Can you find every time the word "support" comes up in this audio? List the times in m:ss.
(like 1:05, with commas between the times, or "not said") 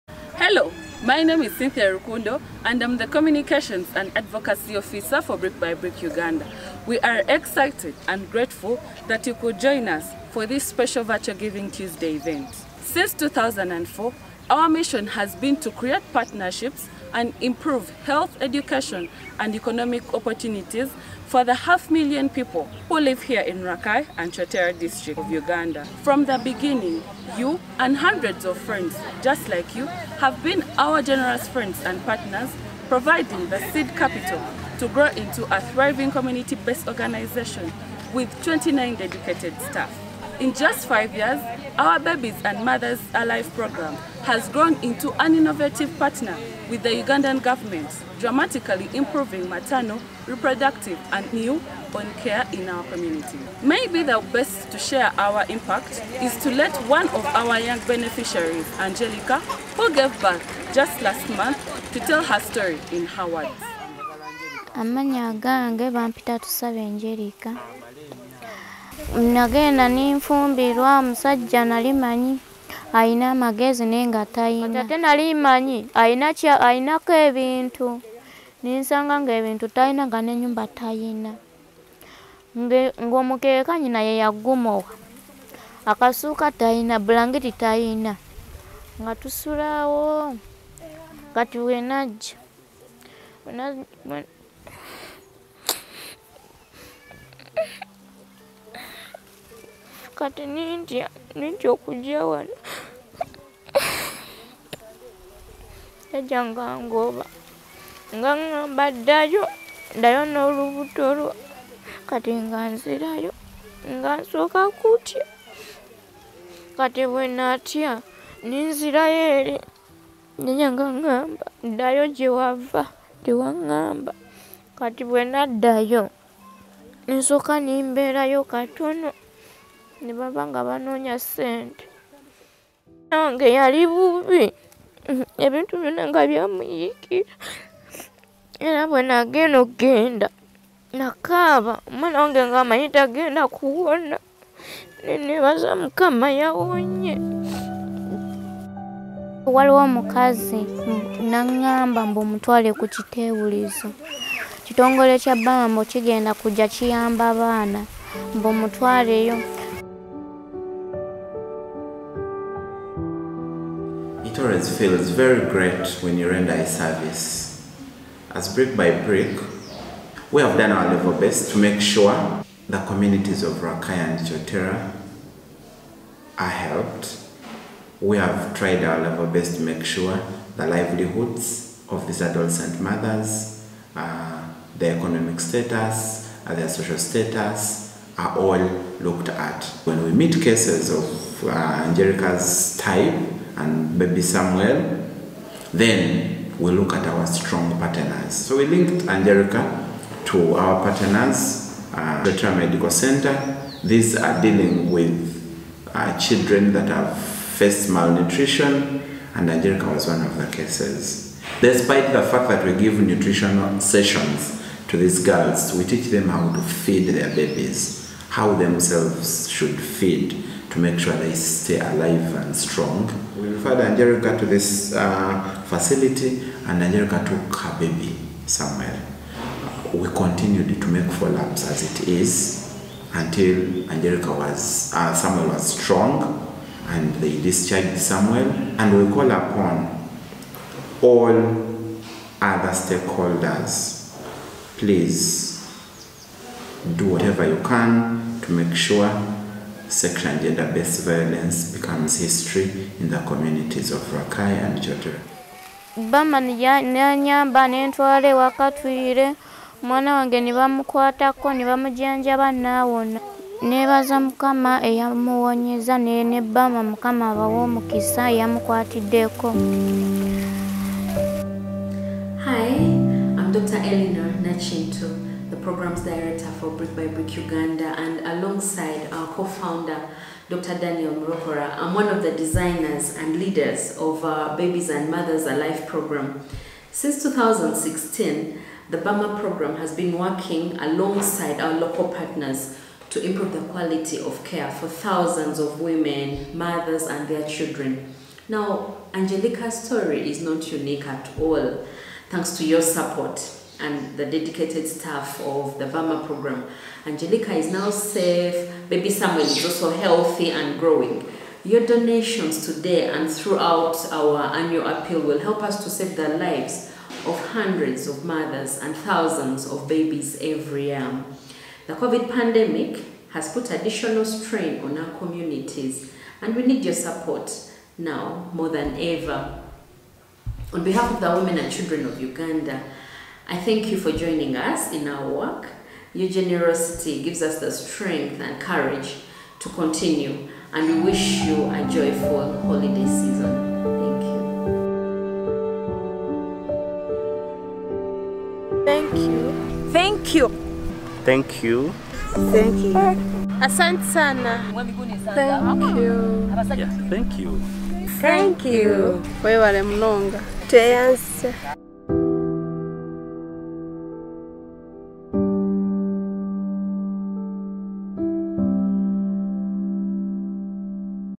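5:02, 5:26.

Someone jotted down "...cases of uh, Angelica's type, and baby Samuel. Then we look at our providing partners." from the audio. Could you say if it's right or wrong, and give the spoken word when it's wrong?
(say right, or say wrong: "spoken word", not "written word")
wrong: "strong", not "providing".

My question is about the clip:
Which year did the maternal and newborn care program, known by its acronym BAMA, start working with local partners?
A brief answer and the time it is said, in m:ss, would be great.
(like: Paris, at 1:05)
2016, at 4:47.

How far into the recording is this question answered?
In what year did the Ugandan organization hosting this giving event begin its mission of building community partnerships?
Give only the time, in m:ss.
0:13.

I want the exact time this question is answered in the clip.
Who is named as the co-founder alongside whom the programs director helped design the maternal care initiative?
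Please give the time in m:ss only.
4:40.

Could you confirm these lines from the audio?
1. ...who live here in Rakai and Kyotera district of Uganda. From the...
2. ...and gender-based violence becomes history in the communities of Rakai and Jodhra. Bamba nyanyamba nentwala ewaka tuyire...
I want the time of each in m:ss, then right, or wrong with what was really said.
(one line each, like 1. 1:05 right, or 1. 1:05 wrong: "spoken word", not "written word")
1. 0:22 right
2. 4:10 right.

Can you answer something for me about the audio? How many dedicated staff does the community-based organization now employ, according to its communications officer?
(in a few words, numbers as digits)
29.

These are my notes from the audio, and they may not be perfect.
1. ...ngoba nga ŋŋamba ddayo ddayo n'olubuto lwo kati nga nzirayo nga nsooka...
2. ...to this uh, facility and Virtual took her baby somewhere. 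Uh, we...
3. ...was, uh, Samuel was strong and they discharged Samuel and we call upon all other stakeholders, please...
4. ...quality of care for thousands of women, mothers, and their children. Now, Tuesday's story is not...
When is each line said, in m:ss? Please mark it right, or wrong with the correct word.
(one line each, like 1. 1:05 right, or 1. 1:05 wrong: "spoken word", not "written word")
1. 1:46 right
2. 3:44 wrong: "Angelica", not "Virtual"
3. 3:54 right
4. 4:53 wrong: "Angelica", not "Tuesday".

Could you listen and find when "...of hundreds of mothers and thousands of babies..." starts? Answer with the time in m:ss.
5:17.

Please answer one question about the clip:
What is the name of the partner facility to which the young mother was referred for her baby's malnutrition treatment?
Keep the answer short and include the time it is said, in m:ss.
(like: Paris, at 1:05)
Veteran Medical Center, at 3:22.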